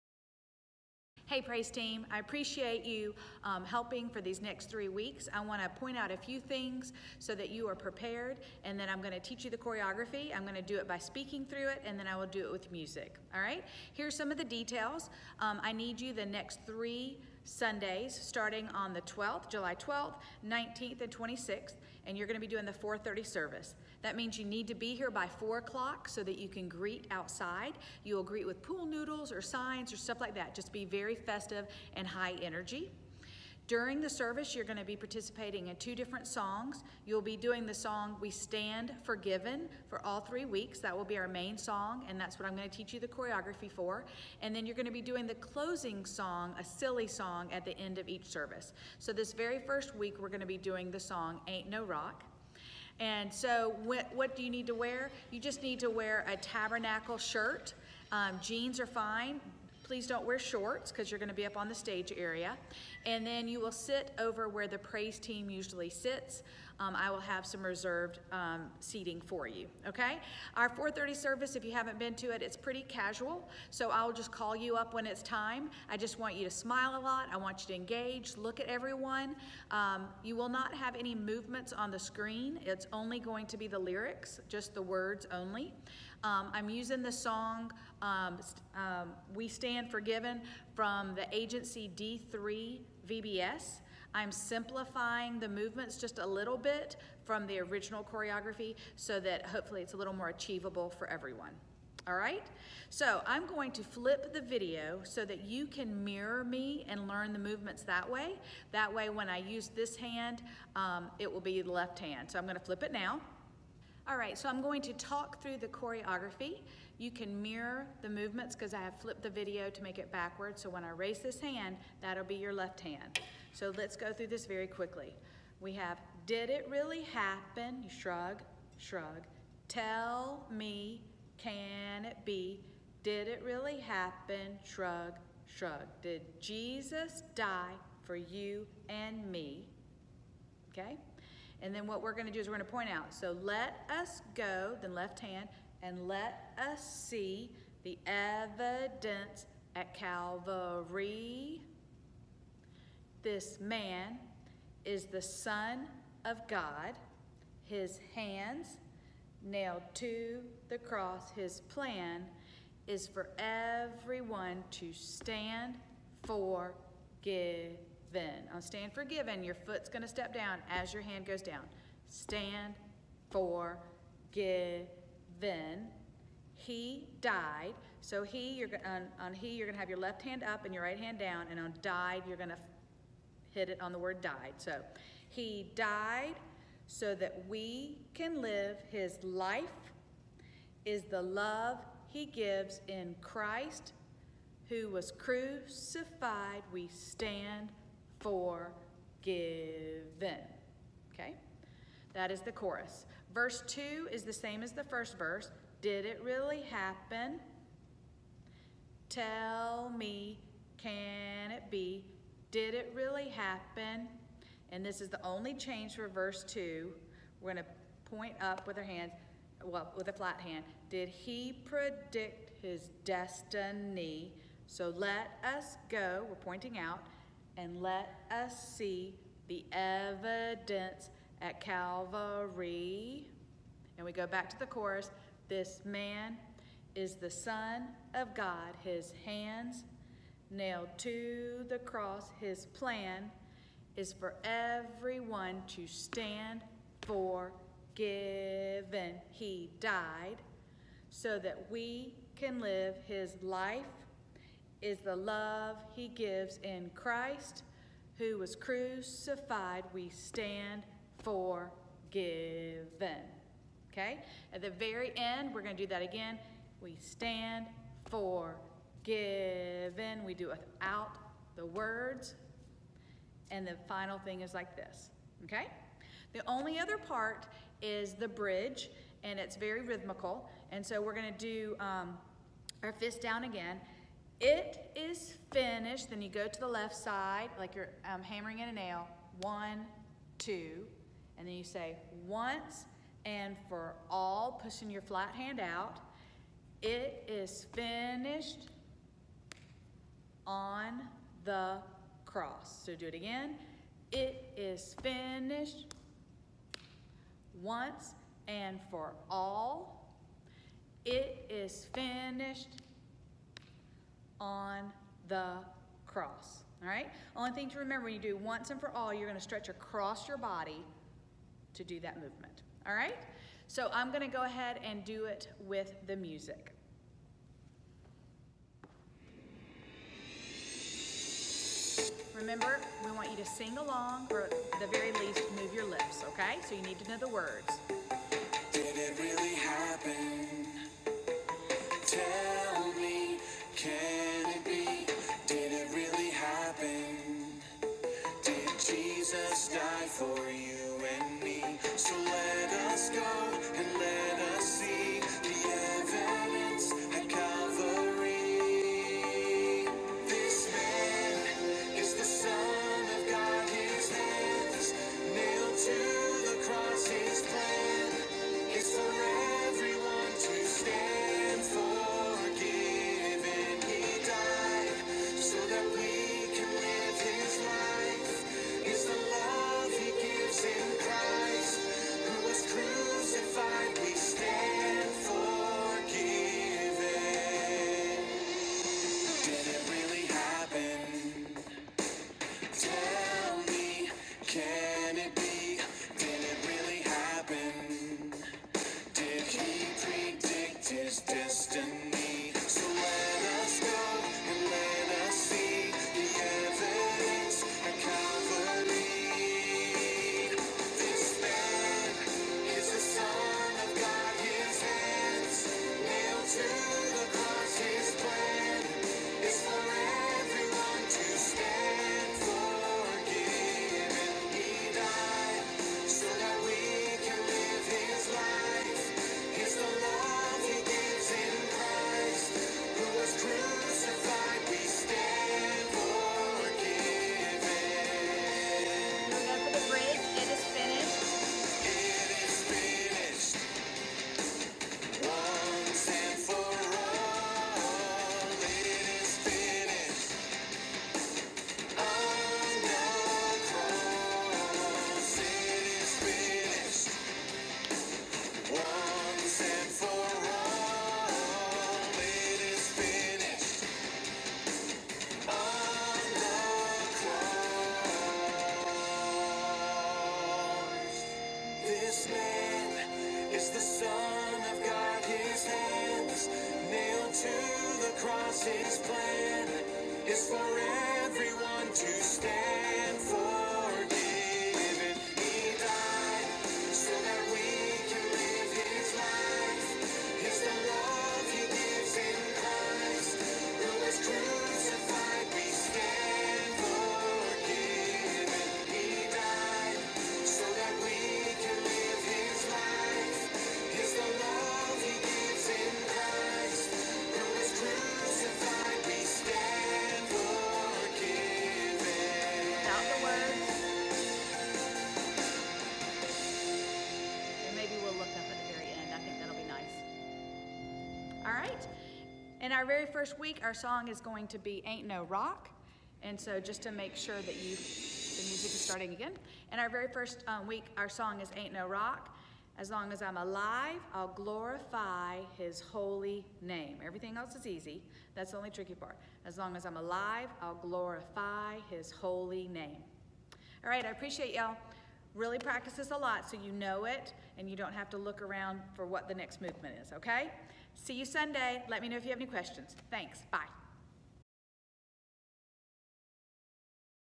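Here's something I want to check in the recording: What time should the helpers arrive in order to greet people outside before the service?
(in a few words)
4:00.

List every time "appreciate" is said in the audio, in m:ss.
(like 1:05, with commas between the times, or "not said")
0:02, 9:04.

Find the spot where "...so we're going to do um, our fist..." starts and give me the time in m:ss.
4:40.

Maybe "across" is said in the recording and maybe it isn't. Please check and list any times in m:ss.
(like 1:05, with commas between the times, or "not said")
5:19.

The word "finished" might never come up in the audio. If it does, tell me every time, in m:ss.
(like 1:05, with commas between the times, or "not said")
4:45, 4:57, 5:05, 5:11.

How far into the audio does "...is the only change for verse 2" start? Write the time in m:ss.
3:35.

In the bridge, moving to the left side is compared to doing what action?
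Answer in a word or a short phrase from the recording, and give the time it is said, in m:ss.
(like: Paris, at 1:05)
Hammering in a nail, at 4:48.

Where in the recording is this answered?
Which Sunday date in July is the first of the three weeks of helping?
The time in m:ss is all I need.
0:19.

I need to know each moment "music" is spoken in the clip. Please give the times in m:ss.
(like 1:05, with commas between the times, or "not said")
0:12, 5:26, 8:48.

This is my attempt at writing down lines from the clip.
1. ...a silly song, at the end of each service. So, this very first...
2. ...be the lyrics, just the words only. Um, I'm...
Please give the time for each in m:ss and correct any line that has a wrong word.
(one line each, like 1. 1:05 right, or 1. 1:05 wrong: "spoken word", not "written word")
1. 0:46 right
2. 1:23 right.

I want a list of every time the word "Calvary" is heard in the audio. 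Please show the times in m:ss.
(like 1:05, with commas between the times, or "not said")
2:29, 3:51.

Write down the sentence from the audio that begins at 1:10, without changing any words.
Our 4.30 service, if you haven't been to it, it's pretty casual, so I'll just call you up when it's time.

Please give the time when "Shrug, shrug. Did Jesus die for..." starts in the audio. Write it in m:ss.
2:14.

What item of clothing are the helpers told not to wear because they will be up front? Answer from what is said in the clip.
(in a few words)
Shorts.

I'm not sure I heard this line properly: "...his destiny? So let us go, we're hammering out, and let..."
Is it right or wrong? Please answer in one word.
wrong.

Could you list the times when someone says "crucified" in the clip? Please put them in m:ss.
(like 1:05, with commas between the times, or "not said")
3:15, 4:18.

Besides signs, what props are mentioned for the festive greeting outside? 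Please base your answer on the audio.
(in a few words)
Pool noodles.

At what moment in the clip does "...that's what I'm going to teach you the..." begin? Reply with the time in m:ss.
0:42.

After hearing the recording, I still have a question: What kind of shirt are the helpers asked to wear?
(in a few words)
Tabernacle shirt.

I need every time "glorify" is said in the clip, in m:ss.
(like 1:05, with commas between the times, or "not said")
8:54, 9:00.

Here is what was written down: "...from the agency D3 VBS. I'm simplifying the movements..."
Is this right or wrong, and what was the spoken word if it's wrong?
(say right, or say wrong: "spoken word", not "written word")
right.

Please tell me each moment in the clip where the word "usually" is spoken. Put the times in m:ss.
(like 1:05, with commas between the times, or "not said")
1:05.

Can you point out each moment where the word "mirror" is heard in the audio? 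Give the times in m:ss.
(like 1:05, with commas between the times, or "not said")
1:46, 1:57.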